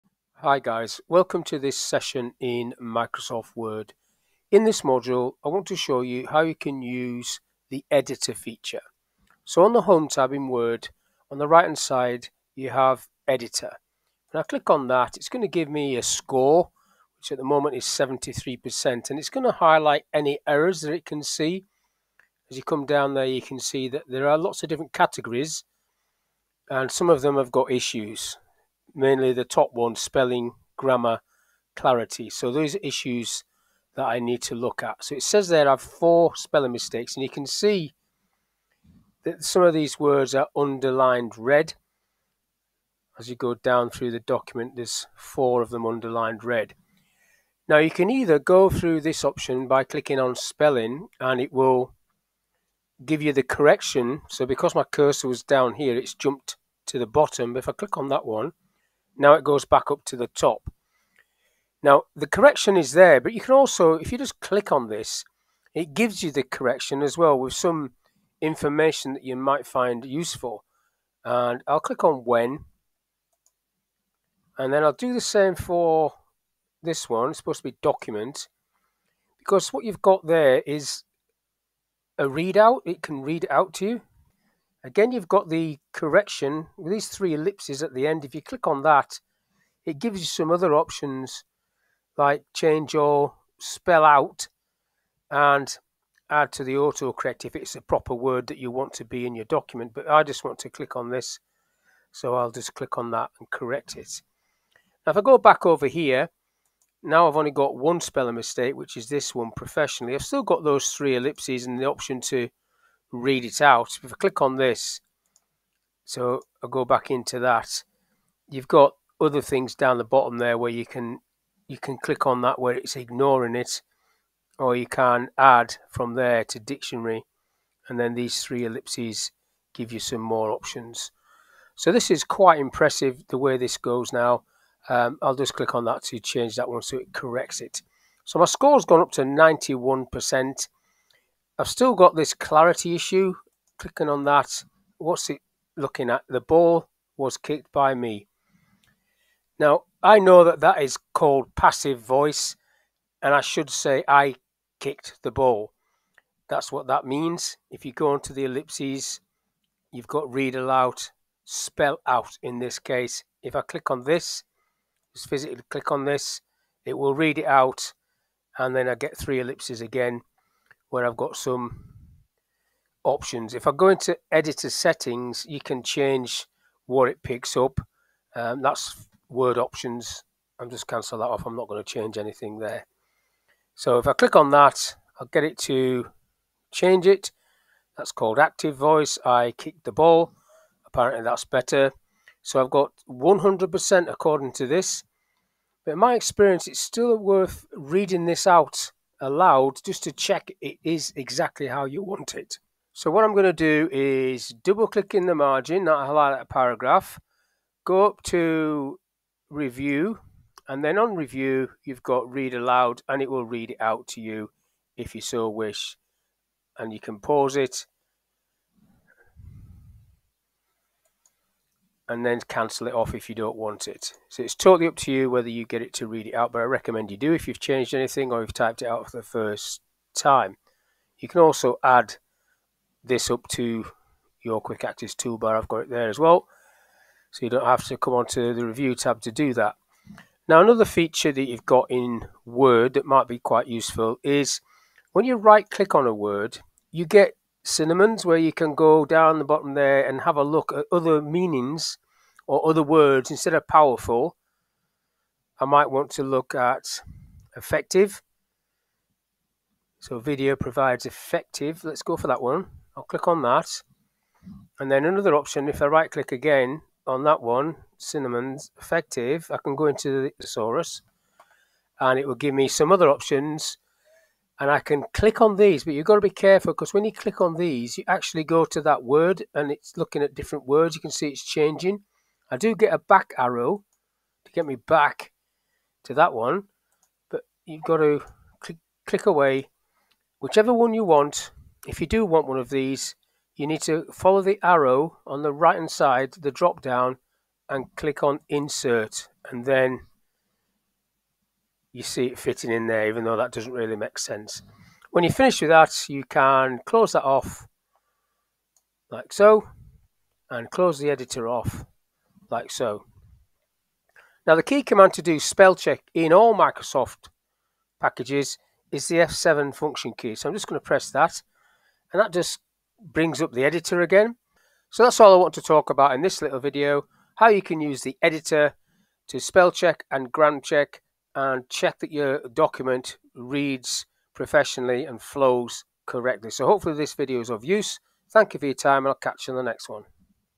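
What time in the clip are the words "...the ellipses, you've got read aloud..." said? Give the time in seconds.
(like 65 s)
158 s.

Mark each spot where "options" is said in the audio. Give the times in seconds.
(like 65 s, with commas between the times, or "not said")
49 s, 90 s, 111 s, 130 s, 173 s, 179 s, 265 s, 273 s.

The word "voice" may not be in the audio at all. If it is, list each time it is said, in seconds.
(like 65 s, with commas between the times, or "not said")
151 s, 188 s.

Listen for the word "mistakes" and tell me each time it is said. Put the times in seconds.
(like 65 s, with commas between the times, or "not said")
36 s, 108 s.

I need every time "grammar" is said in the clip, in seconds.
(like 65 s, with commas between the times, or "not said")
30 s, 330 s.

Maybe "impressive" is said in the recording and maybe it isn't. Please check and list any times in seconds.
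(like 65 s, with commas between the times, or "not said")
132 s.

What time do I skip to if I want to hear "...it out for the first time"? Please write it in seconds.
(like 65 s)
228 s.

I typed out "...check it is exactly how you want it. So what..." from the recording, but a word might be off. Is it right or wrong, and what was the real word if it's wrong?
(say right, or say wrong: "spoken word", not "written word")
right.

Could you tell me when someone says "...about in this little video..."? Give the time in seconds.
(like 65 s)
325 s.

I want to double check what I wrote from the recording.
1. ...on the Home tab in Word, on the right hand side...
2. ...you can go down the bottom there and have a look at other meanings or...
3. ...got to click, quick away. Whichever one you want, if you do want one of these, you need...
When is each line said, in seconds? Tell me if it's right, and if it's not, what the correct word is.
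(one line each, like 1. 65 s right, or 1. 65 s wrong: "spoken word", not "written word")
1. 9 s right
2. 248 s right
3. 287 s wrong: "click", not "quick".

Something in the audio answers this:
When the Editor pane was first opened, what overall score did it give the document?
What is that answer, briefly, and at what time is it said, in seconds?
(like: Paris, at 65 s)
73%, at 17 s.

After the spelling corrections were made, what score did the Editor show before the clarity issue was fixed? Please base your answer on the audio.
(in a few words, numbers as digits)
91%.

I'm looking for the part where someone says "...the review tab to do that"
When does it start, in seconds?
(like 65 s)
238 s.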